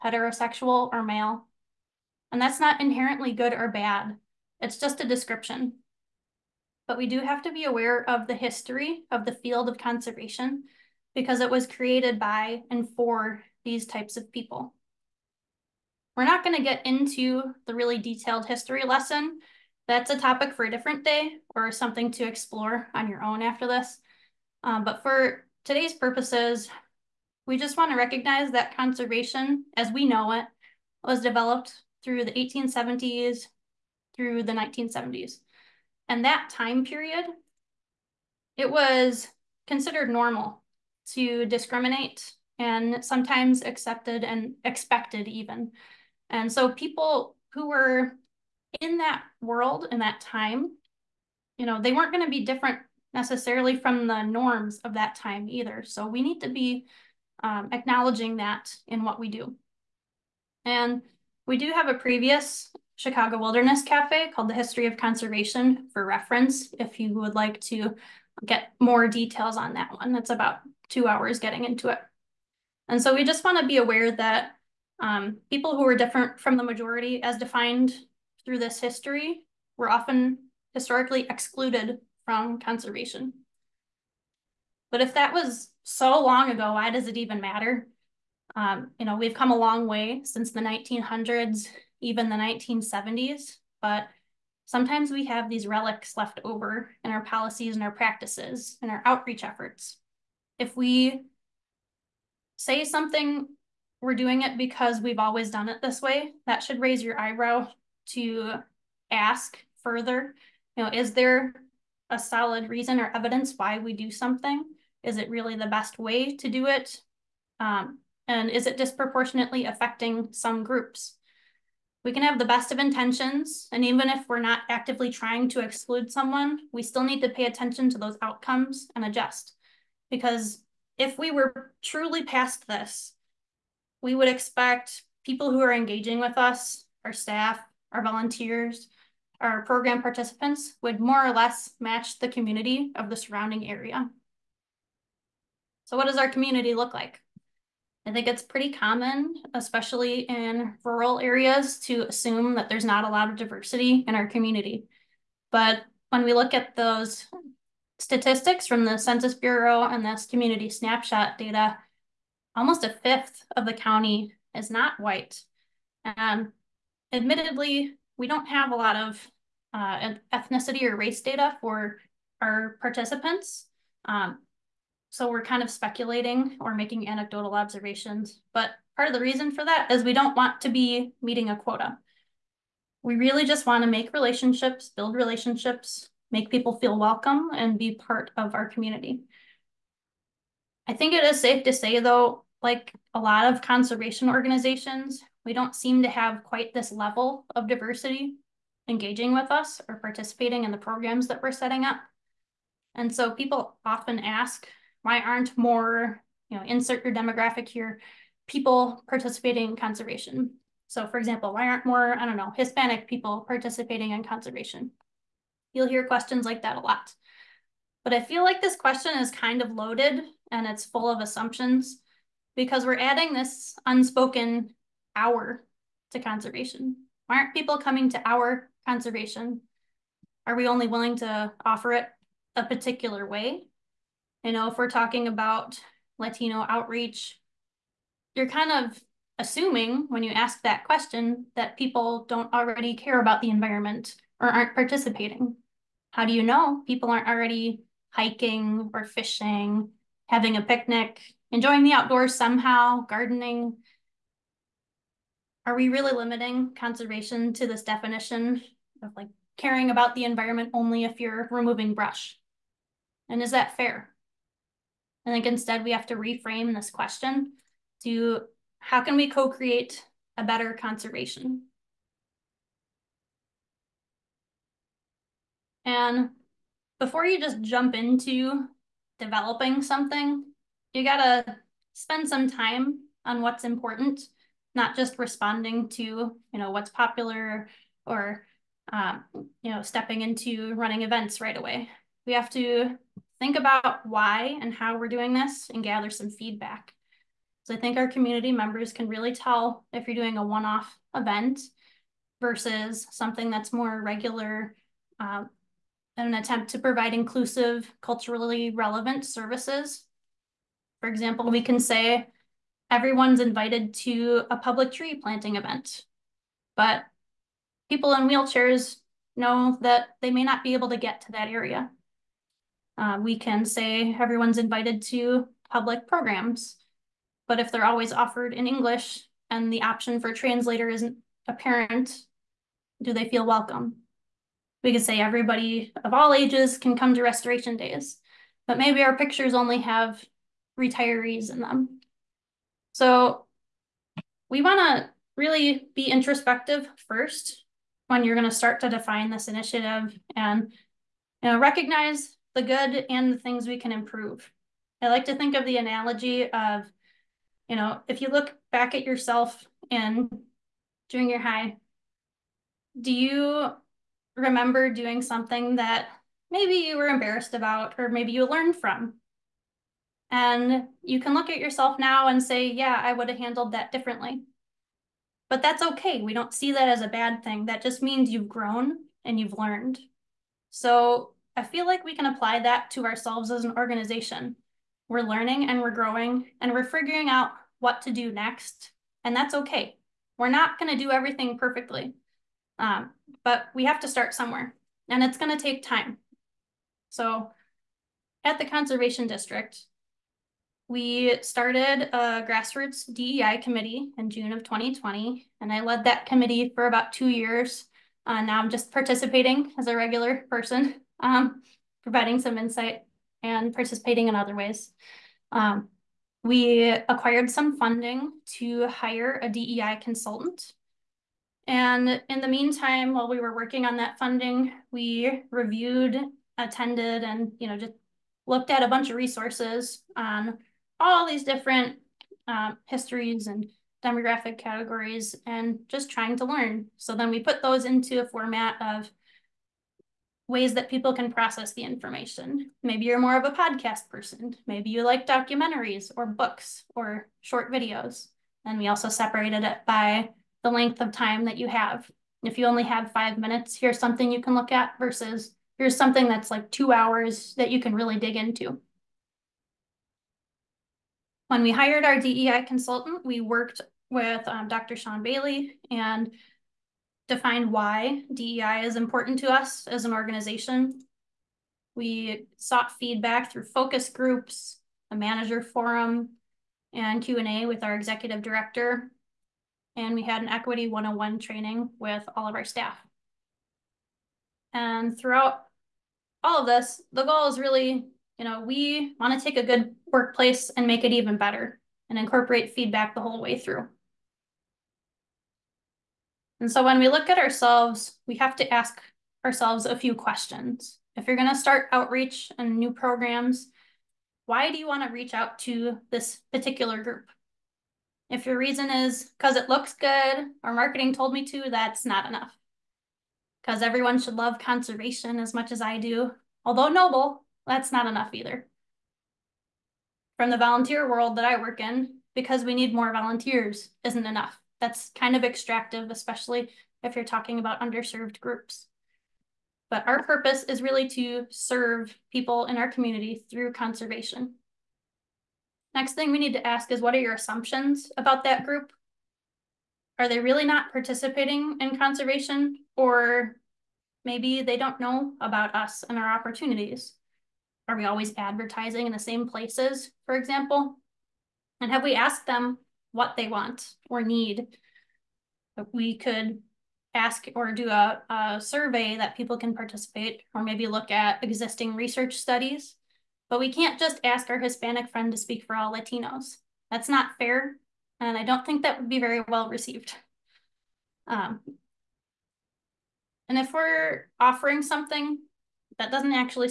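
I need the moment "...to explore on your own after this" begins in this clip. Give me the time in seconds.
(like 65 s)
22 s.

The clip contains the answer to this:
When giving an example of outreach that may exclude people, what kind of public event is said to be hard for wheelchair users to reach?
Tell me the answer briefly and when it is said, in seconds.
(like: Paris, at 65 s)
Tree planting, at 314 s.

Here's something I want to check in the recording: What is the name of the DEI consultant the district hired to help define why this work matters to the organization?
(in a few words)
Dr. Sean Bailey.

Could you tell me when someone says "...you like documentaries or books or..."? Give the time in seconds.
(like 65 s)
444 s.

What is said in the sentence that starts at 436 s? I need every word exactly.
So then we put those into a format of ways that people can process the information.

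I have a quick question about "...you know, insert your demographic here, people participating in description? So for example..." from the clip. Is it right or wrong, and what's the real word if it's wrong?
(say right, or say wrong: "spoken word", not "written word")
wrong: "conservation", not "description".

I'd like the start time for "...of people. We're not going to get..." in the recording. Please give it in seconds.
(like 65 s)
14 s.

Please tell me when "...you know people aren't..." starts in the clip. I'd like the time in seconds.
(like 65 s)
246 s.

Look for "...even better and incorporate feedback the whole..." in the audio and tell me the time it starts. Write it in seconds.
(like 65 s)
491 s.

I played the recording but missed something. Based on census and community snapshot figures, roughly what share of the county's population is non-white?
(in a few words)
Almost a fifth.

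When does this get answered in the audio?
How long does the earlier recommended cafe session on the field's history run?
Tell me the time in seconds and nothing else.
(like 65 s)
70 s.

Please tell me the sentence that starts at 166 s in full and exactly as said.
And um, admittedly, we don't have a lot of uh, ethnicity or race data for our participants.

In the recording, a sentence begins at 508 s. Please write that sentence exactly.
If your reason is because it looks good or marketing told me to, that's not enough.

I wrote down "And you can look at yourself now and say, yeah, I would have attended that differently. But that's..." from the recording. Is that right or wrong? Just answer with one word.
wrong.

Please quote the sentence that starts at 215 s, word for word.
You'll hear questions like that a lot.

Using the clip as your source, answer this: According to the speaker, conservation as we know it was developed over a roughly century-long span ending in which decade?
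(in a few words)
1970s.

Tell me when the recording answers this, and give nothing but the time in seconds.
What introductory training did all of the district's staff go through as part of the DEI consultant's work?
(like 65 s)
480 s.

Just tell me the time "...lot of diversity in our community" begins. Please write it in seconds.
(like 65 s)
153 s.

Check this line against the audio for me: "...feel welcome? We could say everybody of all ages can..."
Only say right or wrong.
right.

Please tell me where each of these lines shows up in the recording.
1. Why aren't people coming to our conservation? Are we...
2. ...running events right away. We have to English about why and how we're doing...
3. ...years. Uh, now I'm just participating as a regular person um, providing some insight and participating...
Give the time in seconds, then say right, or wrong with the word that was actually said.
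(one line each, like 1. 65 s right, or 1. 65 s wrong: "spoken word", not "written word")
1. 227 s right
2. 290 s wrong: "Think", not "English"
3. 407 s right.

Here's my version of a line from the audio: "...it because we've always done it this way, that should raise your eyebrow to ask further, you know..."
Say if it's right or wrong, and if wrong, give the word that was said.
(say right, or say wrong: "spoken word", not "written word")
right.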